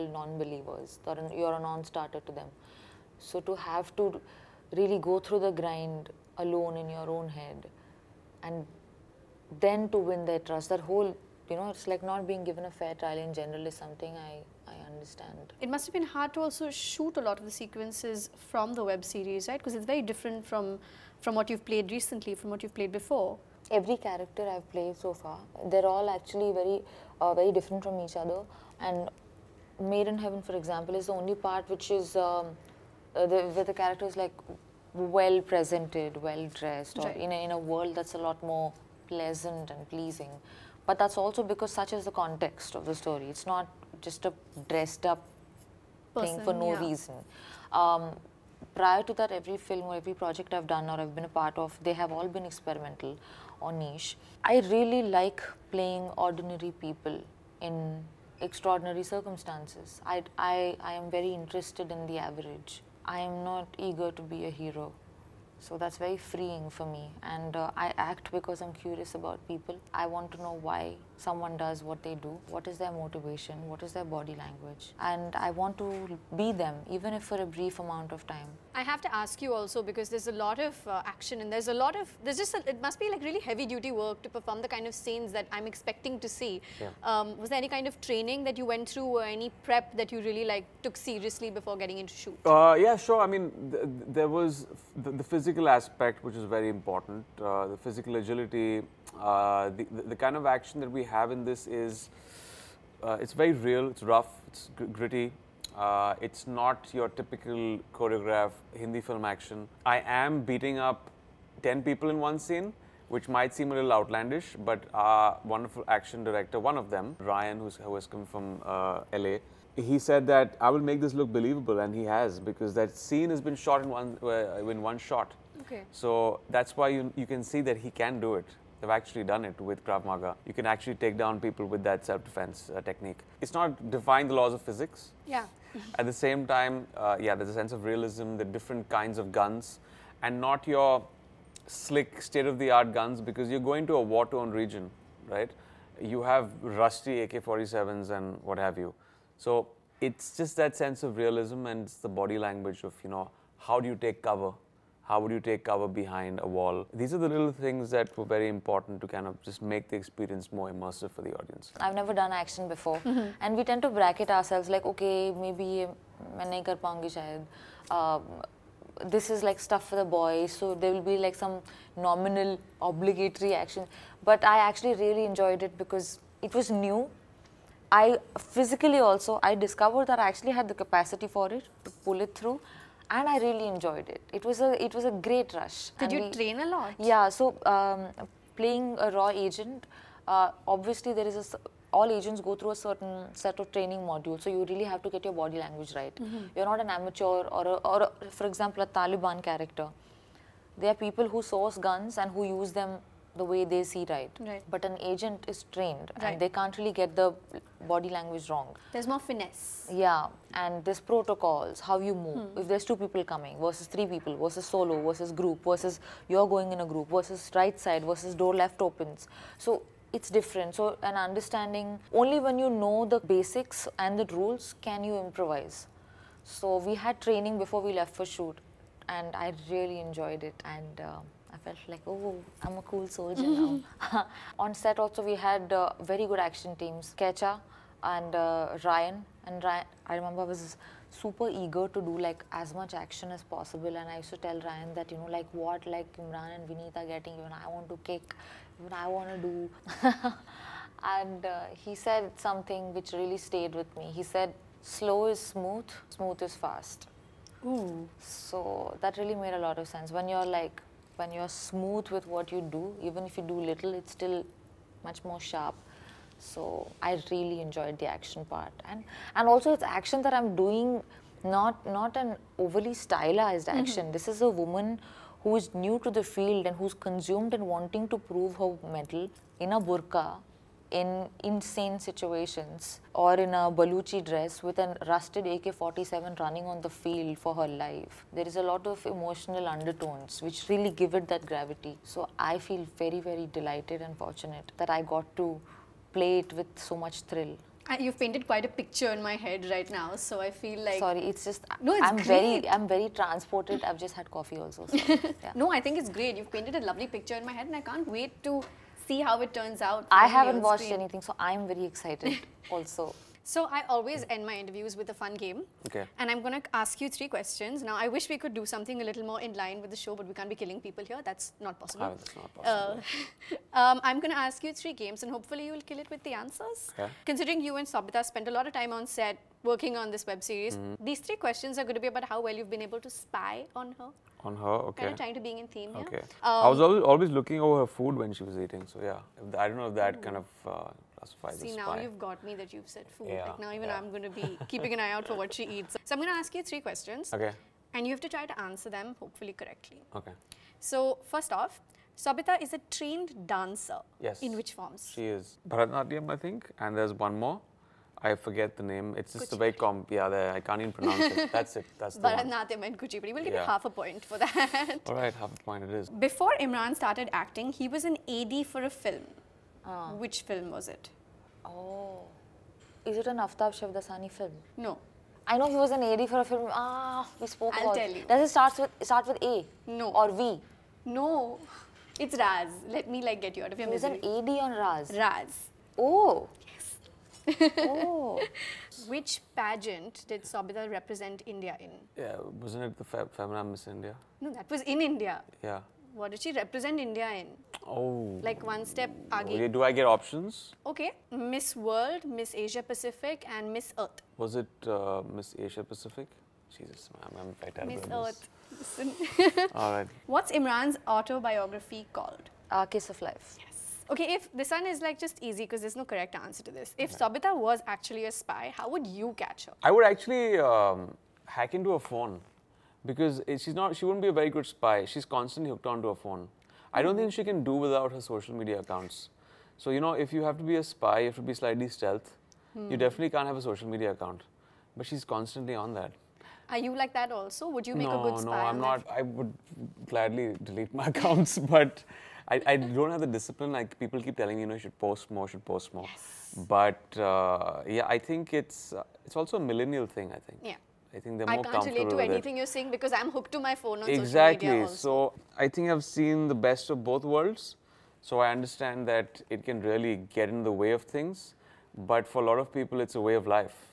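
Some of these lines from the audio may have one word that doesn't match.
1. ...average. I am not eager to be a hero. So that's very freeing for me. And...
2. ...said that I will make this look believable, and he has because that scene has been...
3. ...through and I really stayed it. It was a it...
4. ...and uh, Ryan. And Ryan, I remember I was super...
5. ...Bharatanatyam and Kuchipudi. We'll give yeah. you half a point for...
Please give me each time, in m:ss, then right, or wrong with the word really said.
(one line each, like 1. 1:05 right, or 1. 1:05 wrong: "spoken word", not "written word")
1. 1:02 right
2. 1:59 right
3. 3:02 wrong: "enjoyed", not "stayed"
4. 3:58 right
5. 6:02 right.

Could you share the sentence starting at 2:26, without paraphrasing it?
You have rusty AK-47s and what have you.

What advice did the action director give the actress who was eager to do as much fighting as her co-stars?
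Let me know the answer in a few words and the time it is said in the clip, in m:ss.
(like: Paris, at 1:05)
Slow is smooth, smooth is fast, at 4:14.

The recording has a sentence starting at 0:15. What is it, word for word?
It must have been hard to also shoot a lot of the sequences from the web series, right?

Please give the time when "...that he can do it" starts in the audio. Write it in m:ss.
2:07.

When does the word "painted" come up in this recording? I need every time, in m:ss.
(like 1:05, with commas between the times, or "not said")
4:58, 5:06.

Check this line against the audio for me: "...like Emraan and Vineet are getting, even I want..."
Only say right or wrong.
right.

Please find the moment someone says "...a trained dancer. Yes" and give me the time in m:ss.
5:52.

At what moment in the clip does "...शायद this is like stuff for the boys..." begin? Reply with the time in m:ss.
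2:47.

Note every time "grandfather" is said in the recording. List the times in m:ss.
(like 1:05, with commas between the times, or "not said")
not said.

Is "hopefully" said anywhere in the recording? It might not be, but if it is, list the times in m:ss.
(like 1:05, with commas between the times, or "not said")
5:25, 5:49.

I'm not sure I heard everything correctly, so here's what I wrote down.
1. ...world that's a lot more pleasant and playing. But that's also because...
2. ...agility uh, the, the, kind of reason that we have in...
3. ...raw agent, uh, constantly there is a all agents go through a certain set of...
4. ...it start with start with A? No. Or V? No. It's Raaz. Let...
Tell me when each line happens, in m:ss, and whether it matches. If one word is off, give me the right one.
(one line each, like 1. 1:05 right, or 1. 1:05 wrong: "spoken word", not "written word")
1. 0:37 wrong: "pleasing", not "playing"
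2. 1:38 wrong: "action", not "reason"
3. 3:09 wrong: "obviously", not "constantly"
4. 6:18 right.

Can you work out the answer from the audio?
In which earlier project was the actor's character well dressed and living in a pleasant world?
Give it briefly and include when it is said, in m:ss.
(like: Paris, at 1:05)
Made in Heaven, at 0:29.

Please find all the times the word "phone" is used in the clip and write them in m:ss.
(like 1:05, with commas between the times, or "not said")
7:01, 7:06, 7:33.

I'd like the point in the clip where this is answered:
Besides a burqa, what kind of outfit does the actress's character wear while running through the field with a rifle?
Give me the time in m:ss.
4:43.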